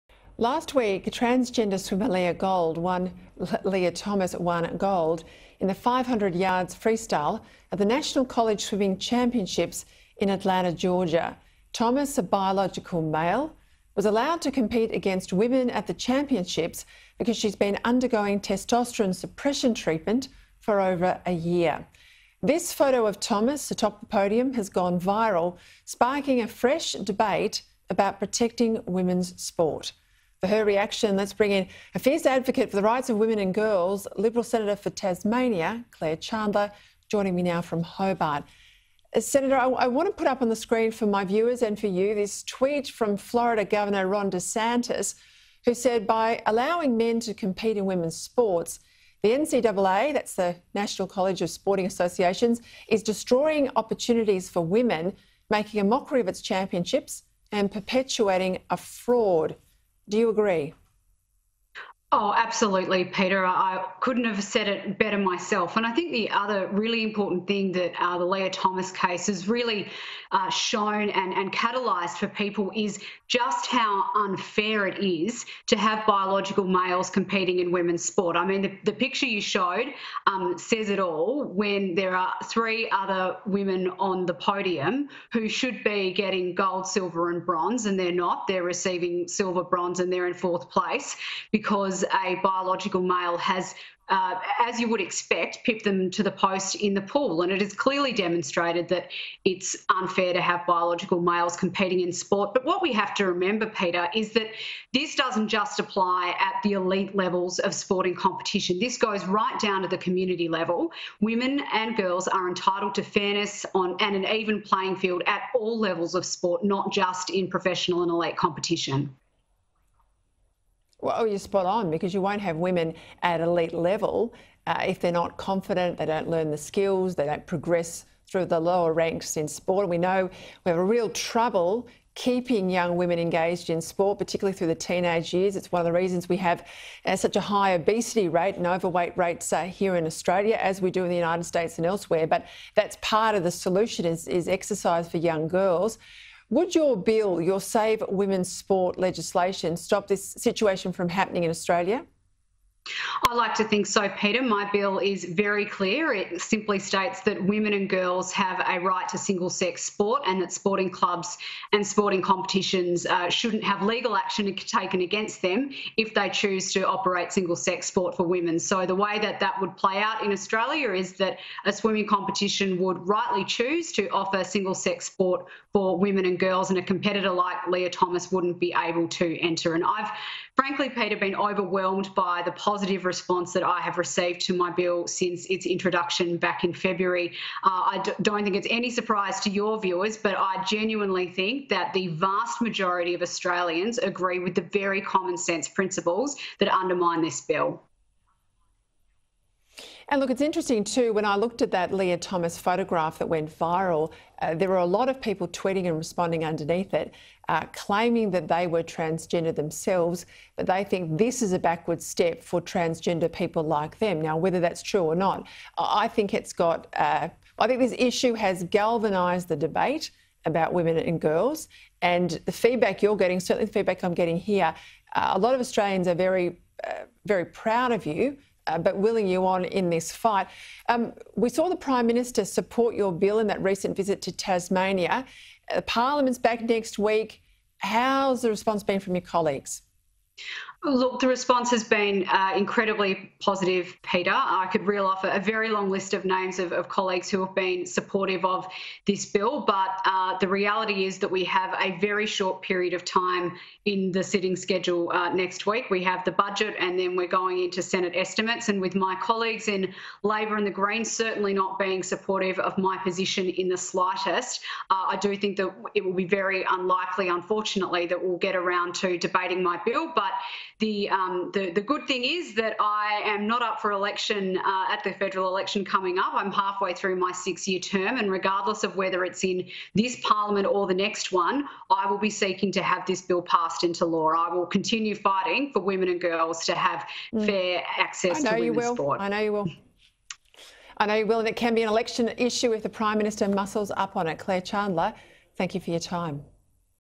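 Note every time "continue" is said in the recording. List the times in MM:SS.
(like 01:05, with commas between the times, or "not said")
04:44.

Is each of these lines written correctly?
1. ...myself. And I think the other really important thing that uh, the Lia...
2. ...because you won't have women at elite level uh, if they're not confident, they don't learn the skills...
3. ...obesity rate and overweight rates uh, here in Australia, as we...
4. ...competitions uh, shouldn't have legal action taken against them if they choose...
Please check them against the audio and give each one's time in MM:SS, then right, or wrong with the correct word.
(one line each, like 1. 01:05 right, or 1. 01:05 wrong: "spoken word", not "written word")
1. 01:05 right
2. 02:01 right
3. 02:17 right
4. 02:42 right.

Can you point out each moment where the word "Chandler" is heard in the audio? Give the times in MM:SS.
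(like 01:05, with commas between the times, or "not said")
00:36, 04:54.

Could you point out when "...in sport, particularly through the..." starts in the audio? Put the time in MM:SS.
02:13.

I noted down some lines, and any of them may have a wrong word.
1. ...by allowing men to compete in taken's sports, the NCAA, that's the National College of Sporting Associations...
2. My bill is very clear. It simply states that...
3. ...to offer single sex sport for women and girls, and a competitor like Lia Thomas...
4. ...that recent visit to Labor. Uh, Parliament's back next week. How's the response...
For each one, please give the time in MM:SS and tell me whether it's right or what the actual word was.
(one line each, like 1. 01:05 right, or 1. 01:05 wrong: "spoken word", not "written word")
1. 00:46 wrong: "women", not "taken"
2. 02:34 right
3. 02:53 right
4. 03:53 wrong: "Tasmania", not "Labor".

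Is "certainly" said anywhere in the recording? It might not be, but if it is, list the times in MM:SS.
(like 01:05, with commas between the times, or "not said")
03:43, 04:21.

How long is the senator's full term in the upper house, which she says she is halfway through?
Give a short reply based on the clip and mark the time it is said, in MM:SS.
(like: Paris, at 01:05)
6 years, at 04:37.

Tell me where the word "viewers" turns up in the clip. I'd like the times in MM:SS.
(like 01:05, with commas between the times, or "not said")
00:41, 03:09.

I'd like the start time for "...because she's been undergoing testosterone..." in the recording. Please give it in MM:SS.
00:17.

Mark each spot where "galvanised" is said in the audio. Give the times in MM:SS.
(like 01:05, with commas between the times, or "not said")
03:38.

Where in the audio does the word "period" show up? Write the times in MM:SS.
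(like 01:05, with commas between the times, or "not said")
04:12.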